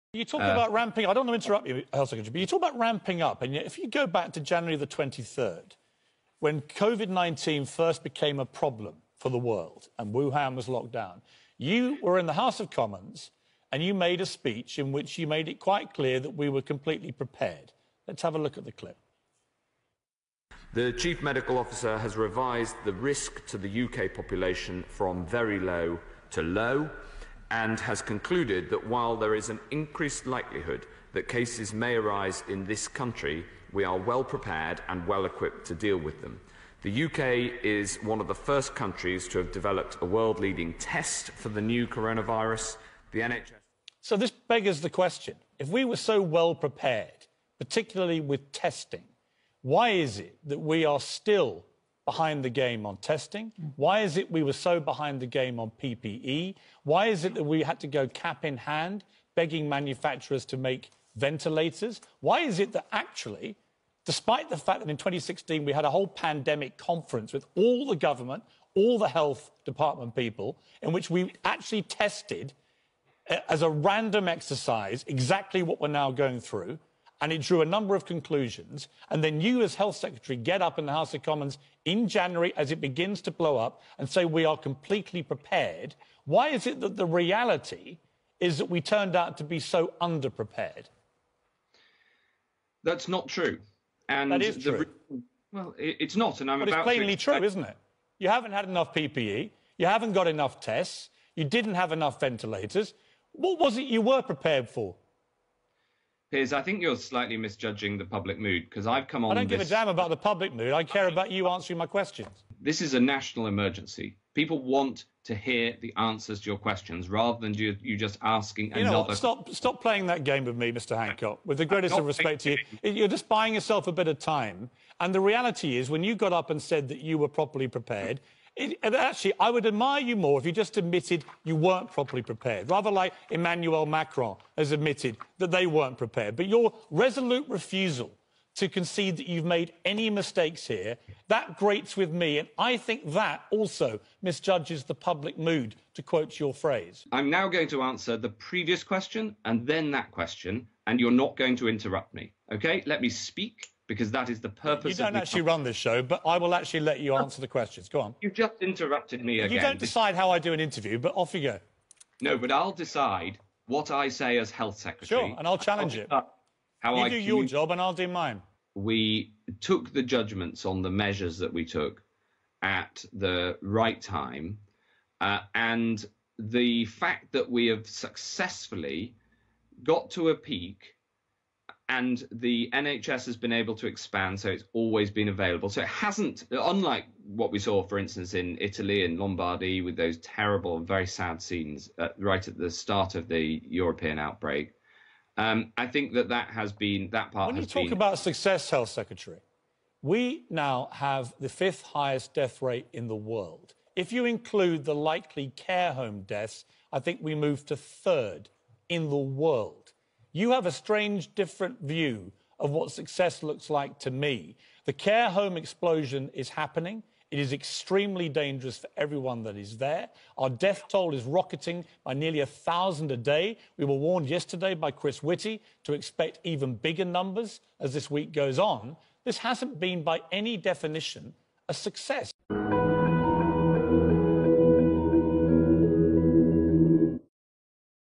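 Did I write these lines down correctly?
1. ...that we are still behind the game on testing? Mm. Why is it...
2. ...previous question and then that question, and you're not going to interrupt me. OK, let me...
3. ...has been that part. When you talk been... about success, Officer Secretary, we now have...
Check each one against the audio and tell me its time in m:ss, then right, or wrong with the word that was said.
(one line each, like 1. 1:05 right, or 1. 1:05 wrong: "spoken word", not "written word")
1. 0:50 right
2. 2:28 right
3. 3:16 wrong: "Health", not "Officer".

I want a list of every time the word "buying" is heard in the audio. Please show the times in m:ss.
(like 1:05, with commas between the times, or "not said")
2:03.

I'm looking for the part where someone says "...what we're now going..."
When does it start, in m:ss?
1:15.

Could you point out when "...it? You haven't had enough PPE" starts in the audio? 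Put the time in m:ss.
1:37.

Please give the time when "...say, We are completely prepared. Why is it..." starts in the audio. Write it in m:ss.
1:24.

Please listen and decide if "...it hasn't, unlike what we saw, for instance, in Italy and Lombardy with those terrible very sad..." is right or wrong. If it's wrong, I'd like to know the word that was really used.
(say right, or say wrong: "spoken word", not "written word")
right.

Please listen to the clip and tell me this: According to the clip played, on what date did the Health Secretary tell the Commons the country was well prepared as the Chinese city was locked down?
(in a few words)
January 23rd.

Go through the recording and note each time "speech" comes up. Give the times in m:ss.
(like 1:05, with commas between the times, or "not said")
0:14.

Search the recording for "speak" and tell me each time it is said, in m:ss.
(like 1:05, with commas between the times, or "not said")
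2:33.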